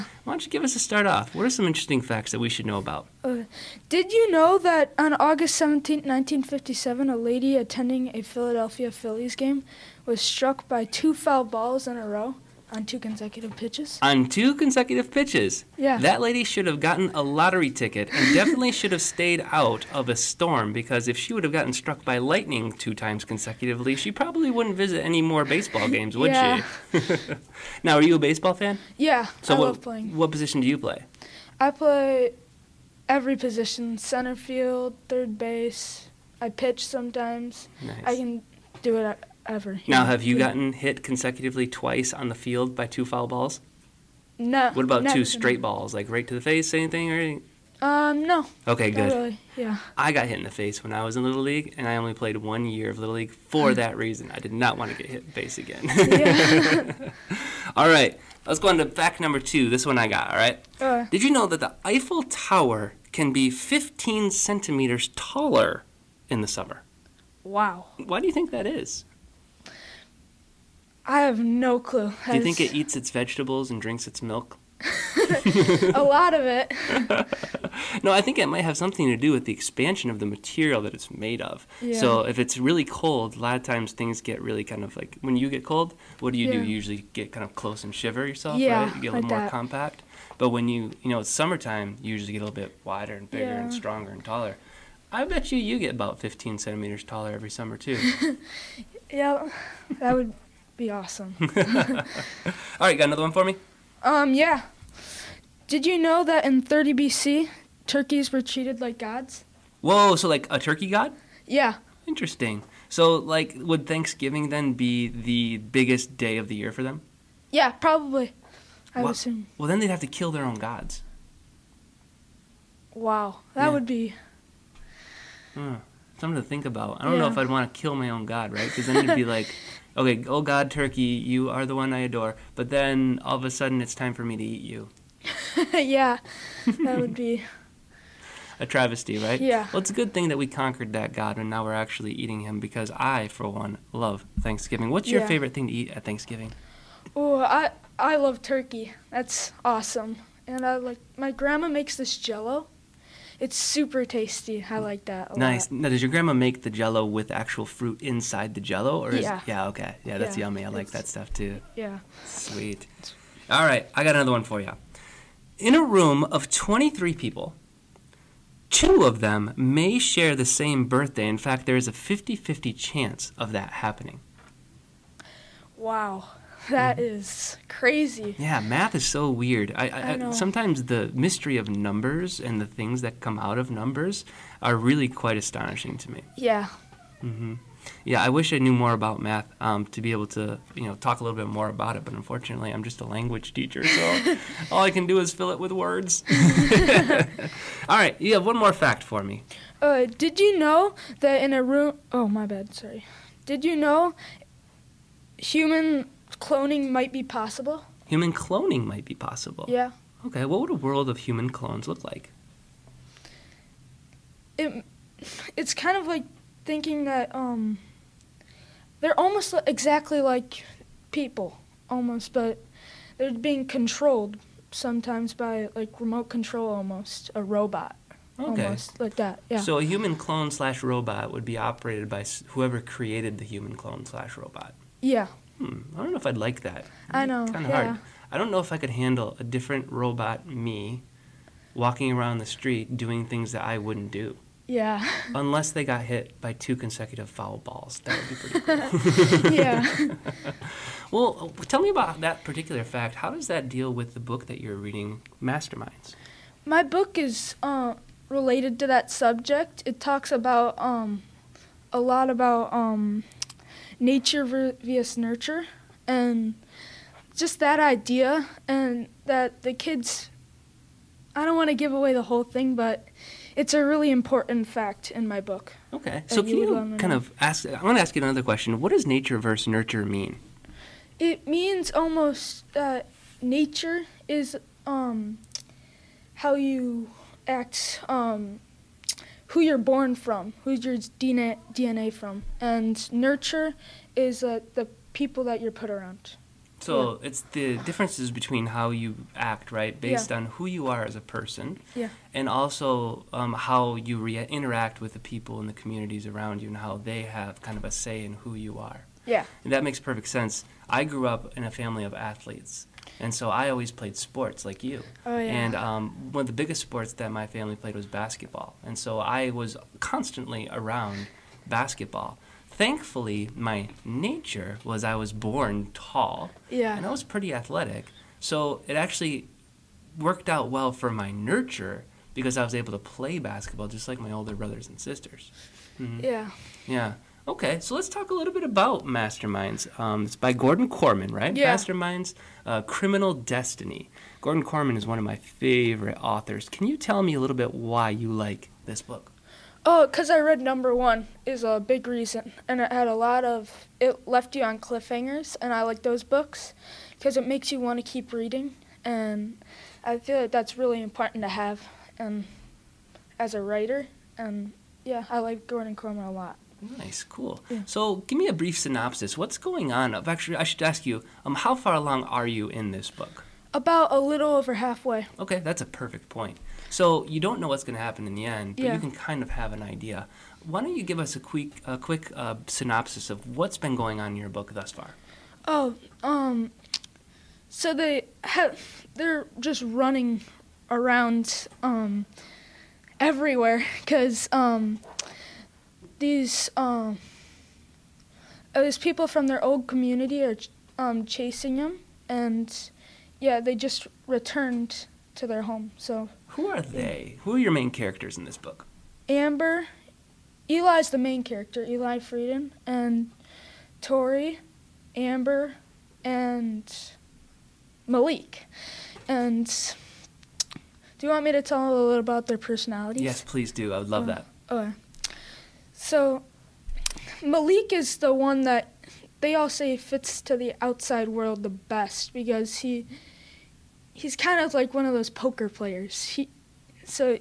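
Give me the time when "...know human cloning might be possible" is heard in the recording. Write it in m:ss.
3:23.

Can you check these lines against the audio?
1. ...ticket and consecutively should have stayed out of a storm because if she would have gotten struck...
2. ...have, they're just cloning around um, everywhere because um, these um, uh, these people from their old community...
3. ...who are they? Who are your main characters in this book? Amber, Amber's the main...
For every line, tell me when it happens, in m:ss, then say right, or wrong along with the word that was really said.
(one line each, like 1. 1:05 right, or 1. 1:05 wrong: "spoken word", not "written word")
1. 0:17 wrong: "definitely", not "consecutively"
2. 6:28 wrong: "running", not "cloning"
3. 6:46 wrong: "Eli", not "Amber".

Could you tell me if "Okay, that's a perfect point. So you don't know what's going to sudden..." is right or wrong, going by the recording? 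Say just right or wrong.
wrong.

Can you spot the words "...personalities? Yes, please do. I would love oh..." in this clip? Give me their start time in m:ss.
7:02.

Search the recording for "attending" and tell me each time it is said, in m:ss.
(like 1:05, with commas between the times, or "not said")
0:07.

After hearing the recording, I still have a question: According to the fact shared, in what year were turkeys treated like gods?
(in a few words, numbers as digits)
30 BC.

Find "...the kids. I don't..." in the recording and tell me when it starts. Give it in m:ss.
4:29.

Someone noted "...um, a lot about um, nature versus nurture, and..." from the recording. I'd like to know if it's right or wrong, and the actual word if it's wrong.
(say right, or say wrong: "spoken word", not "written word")
right.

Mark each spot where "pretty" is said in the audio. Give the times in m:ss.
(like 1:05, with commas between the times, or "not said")
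4:08, 5:27.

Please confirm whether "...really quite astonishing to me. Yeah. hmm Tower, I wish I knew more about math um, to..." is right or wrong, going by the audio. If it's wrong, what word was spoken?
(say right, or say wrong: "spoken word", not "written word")
wrong: "Yeah", not "Tower".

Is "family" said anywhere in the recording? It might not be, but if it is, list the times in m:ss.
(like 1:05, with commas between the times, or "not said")
5:11, 5:17.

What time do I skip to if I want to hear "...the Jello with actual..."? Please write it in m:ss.
2:36.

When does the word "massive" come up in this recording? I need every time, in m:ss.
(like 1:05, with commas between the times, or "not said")
not said.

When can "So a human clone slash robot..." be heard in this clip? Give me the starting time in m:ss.
3:49.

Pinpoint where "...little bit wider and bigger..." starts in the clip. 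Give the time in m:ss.
1:32.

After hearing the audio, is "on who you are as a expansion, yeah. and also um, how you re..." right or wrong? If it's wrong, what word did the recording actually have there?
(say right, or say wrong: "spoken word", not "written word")
wrong: "person", not "expansion".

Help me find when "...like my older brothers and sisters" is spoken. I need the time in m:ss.
5:34.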